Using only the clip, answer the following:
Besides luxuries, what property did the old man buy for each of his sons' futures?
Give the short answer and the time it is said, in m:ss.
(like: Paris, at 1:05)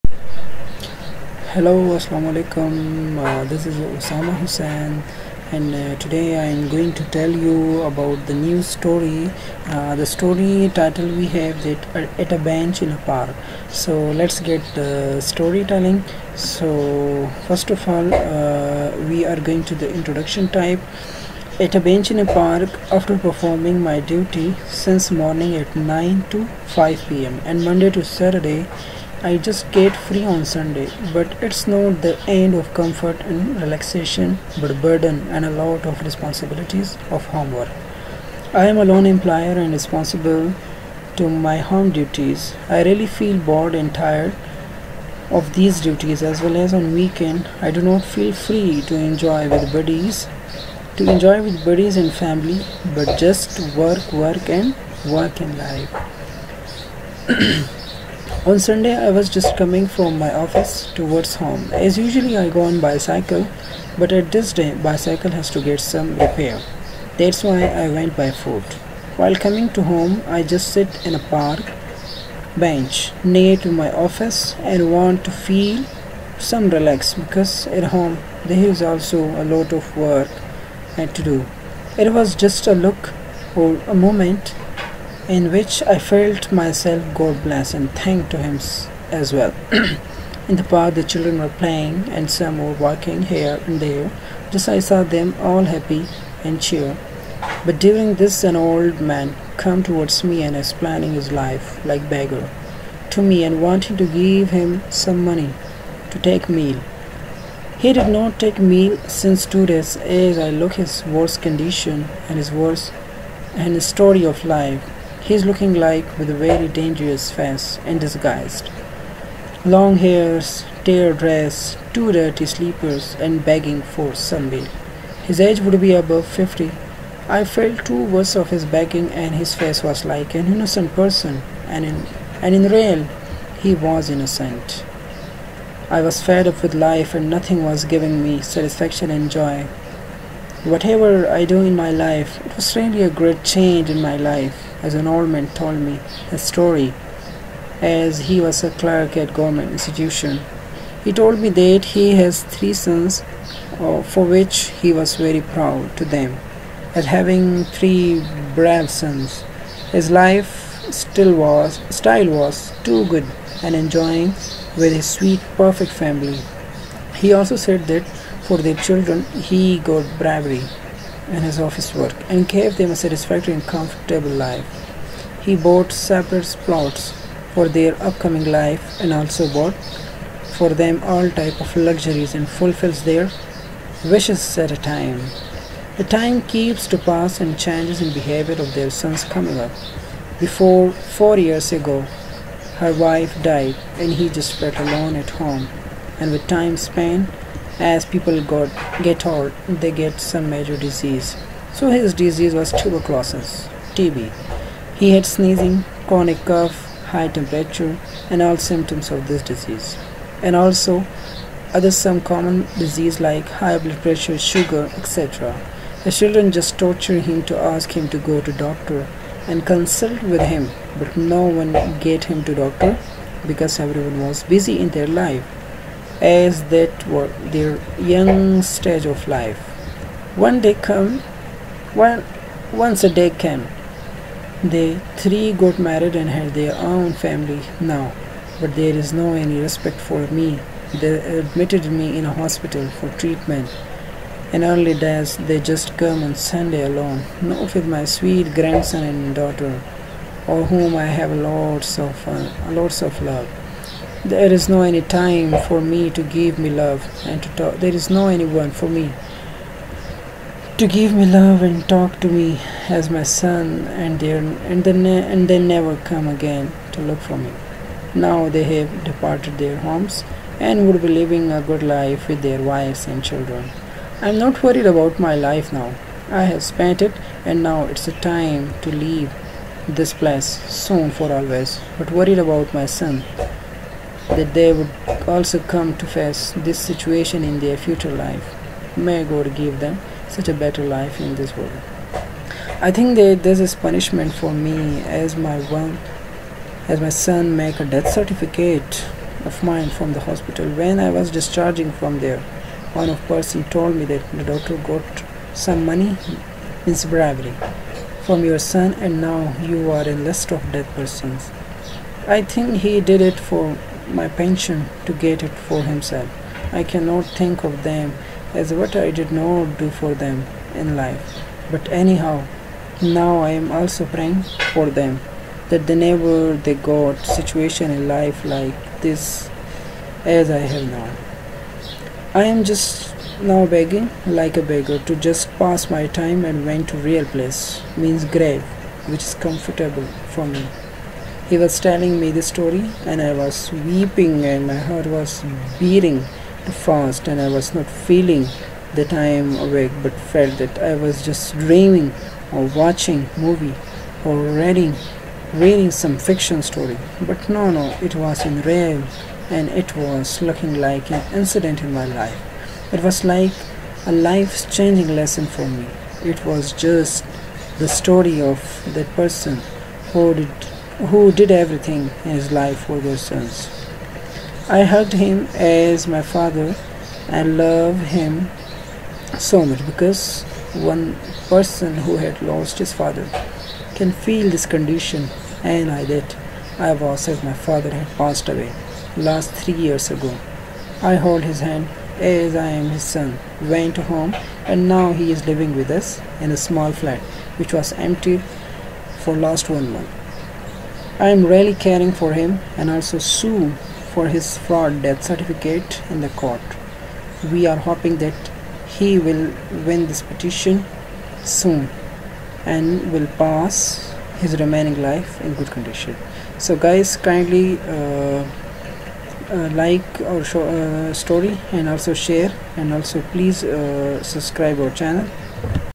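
Separate plots, at 2:55.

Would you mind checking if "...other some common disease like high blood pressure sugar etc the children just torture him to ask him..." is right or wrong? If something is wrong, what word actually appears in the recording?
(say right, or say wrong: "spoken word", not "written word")
right.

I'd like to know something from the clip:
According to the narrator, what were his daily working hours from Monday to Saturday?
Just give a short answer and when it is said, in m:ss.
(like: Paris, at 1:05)
9 to 5, at 0:25.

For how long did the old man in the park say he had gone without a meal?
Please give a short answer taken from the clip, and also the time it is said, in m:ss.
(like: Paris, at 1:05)
2 days, at 1:49.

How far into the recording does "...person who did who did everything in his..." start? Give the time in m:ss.
6:09.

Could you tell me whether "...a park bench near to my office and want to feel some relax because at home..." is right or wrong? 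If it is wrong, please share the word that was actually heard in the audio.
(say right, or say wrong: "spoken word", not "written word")
right.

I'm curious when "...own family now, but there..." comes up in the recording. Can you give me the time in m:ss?
3:56.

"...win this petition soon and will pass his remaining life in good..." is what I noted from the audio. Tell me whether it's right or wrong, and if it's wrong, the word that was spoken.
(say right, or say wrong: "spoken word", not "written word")
right.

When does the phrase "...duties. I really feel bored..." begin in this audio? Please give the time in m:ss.
0:41.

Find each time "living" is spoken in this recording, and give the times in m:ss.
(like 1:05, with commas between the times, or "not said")
4:31, 6:35.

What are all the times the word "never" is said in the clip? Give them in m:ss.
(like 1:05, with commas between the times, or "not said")
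4:25, 5:25.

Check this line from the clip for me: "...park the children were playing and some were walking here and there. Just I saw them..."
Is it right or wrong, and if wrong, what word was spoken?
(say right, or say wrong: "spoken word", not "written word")
right.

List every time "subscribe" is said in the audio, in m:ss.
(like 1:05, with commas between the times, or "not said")
7:04.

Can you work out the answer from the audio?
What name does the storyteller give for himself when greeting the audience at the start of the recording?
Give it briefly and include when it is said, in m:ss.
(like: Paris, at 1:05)
Usama Hussain, at 0:03.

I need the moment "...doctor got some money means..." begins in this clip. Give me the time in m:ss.
5:04.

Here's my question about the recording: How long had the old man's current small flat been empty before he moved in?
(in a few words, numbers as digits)
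1 month.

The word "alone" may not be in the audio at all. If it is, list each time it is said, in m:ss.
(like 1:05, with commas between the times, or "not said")
3:14, 4:06.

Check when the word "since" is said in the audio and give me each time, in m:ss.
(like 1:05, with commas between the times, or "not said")
0:24, 1:49.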